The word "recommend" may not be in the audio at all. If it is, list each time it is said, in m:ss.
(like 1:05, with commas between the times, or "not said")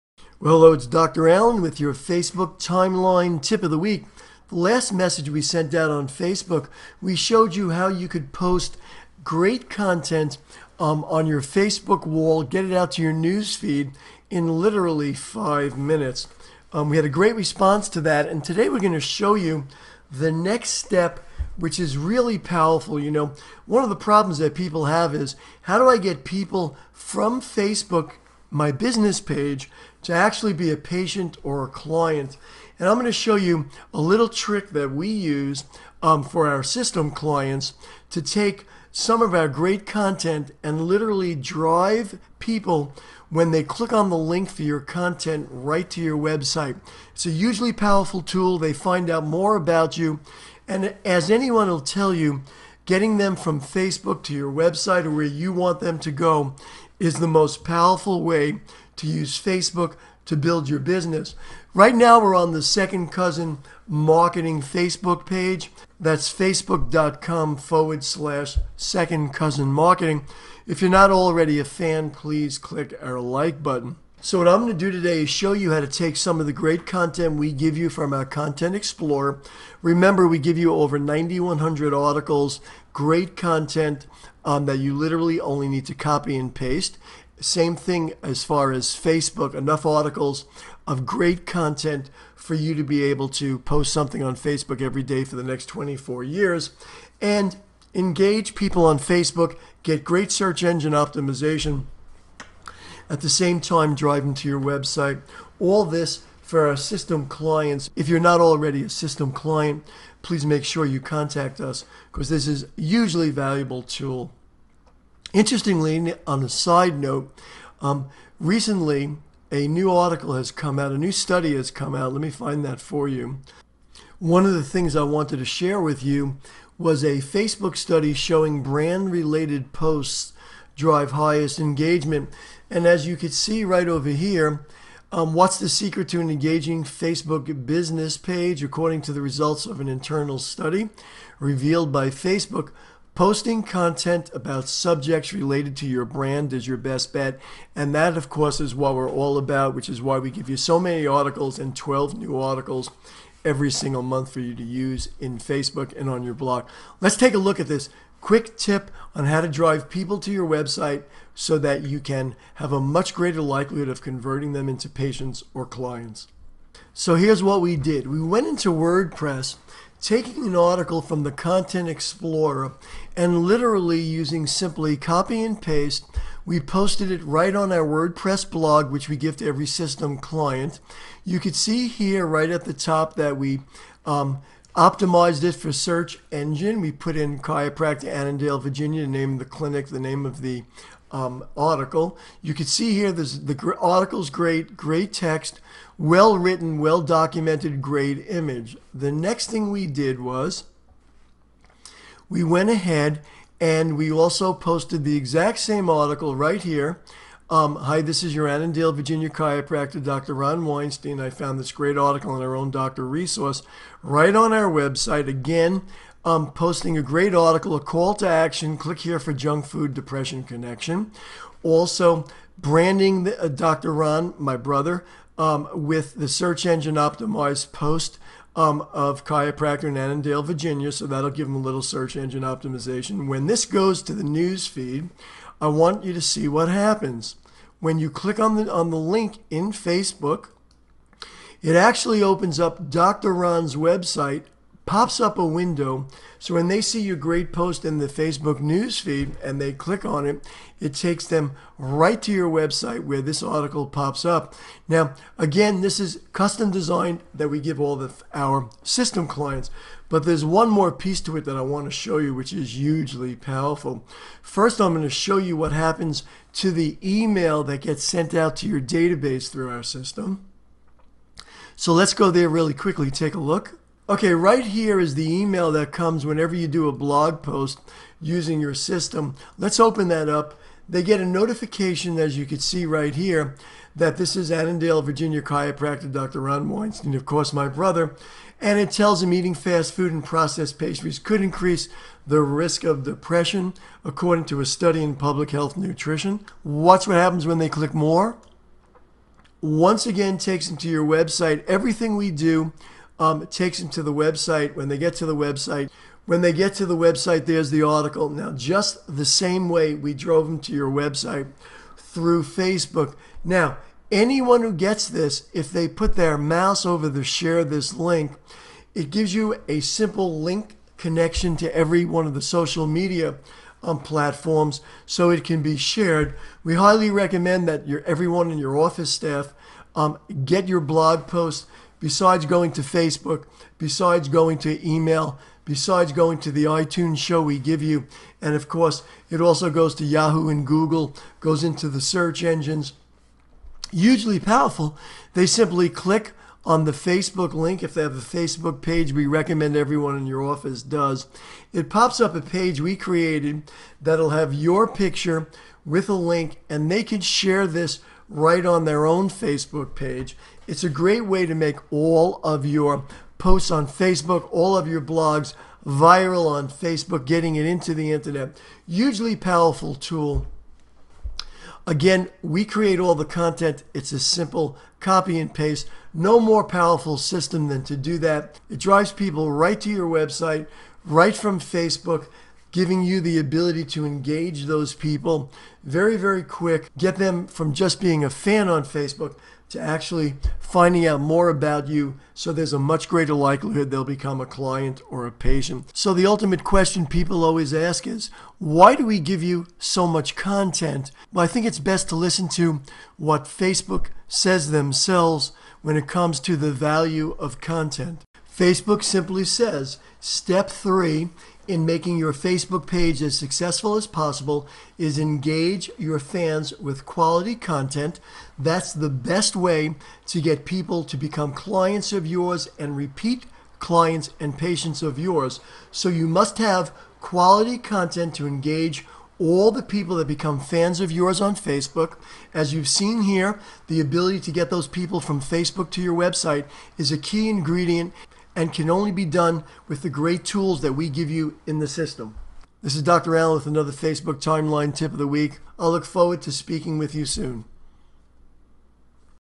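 5:27, 5:49.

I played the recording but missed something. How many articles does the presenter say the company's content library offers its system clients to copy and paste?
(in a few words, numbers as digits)
9,100.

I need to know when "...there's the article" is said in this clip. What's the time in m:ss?
5:07.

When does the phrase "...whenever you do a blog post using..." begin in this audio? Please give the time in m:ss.
4:36.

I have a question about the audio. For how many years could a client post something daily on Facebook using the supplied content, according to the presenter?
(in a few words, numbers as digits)
24.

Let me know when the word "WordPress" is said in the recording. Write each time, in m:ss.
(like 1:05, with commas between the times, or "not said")
2:48, 2:57.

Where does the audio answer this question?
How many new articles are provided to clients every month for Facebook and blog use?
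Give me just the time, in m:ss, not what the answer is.
2:31.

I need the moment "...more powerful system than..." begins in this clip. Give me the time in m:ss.
6:16.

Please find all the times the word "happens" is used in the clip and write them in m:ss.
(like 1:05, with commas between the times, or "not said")
3:56, 4:25, 4:57.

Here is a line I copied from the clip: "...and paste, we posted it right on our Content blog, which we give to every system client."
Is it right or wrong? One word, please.
wrong.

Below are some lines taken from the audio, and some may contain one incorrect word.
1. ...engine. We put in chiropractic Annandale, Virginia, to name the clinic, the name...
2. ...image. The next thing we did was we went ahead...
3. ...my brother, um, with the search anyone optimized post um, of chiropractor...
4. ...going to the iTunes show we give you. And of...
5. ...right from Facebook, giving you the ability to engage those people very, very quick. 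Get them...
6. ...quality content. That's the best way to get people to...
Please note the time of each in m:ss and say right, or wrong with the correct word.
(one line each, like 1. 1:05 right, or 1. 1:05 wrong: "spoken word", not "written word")
1. 3:06 right
2. 3:18 right
3. 3:44 wrong: "engine", not "anyone"
4. 5:36 right
5. 6:21 right
6. 6:57 right.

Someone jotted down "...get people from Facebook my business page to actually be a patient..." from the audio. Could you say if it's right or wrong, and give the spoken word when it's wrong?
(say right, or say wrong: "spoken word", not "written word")
right.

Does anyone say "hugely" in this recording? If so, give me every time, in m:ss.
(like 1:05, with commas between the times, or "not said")
0:47, 1:52, 4:22, 5:43, 6:08.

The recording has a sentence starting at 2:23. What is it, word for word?
Posting content about subjects related to your brand is your best bet.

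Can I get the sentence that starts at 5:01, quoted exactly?
Everything we do um, takes them to the website.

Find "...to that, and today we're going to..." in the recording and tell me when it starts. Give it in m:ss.
0:17.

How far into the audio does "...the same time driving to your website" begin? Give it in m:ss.
1:43.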